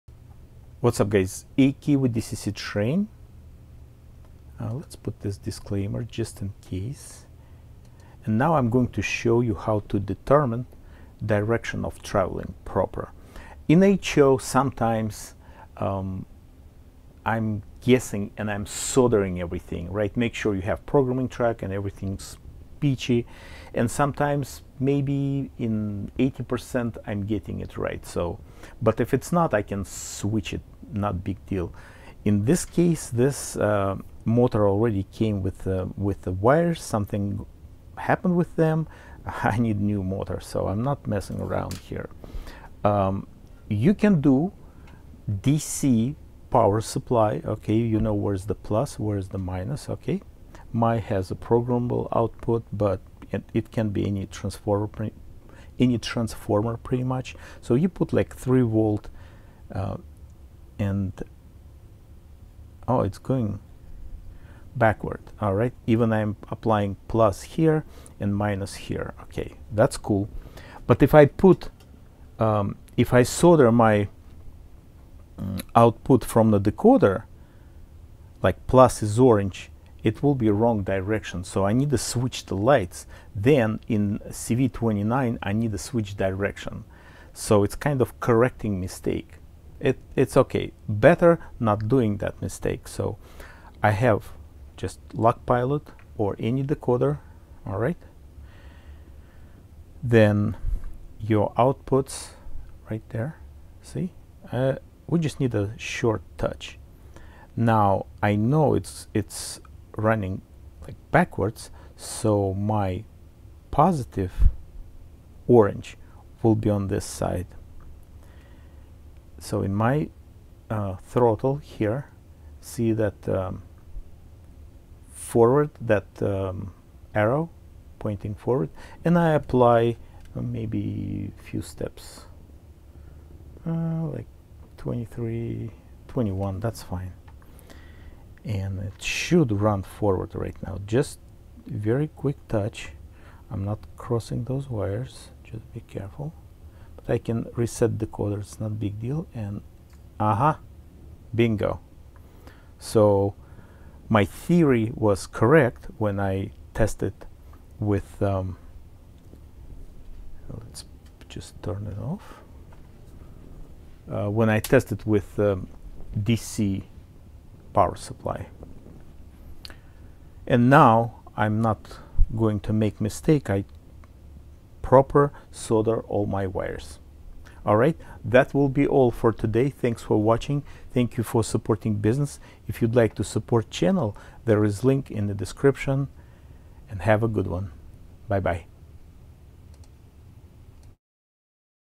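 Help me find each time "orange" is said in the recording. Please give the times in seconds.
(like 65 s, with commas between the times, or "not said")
79 s, 115 s.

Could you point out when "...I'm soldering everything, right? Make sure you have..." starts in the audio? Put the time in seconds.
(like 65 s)
18 s.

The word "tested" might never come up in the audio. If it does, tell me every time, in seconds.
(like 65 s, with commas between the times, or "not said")
156 s, 164 s.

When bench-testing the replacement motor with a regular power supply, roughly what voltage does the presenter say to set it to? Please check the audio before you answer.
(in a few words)
3 volts.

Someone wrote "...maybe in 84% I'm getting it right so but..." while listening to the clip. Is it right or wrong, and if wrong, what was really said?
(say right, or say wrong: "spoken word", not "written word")
wrong: "80", not "84".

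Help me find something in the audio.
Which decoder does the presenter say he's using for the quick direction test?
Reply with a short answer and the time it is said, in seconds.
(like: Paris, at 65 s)
LokPilot, at 95 s.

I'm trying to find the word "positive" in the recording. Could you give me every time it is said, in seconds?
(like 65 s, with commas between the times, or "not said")
113 s.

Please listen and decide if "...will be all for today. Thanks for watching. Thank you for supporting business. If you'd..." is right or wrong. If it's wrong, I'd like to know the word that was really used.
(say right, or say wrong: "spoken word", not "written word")
right.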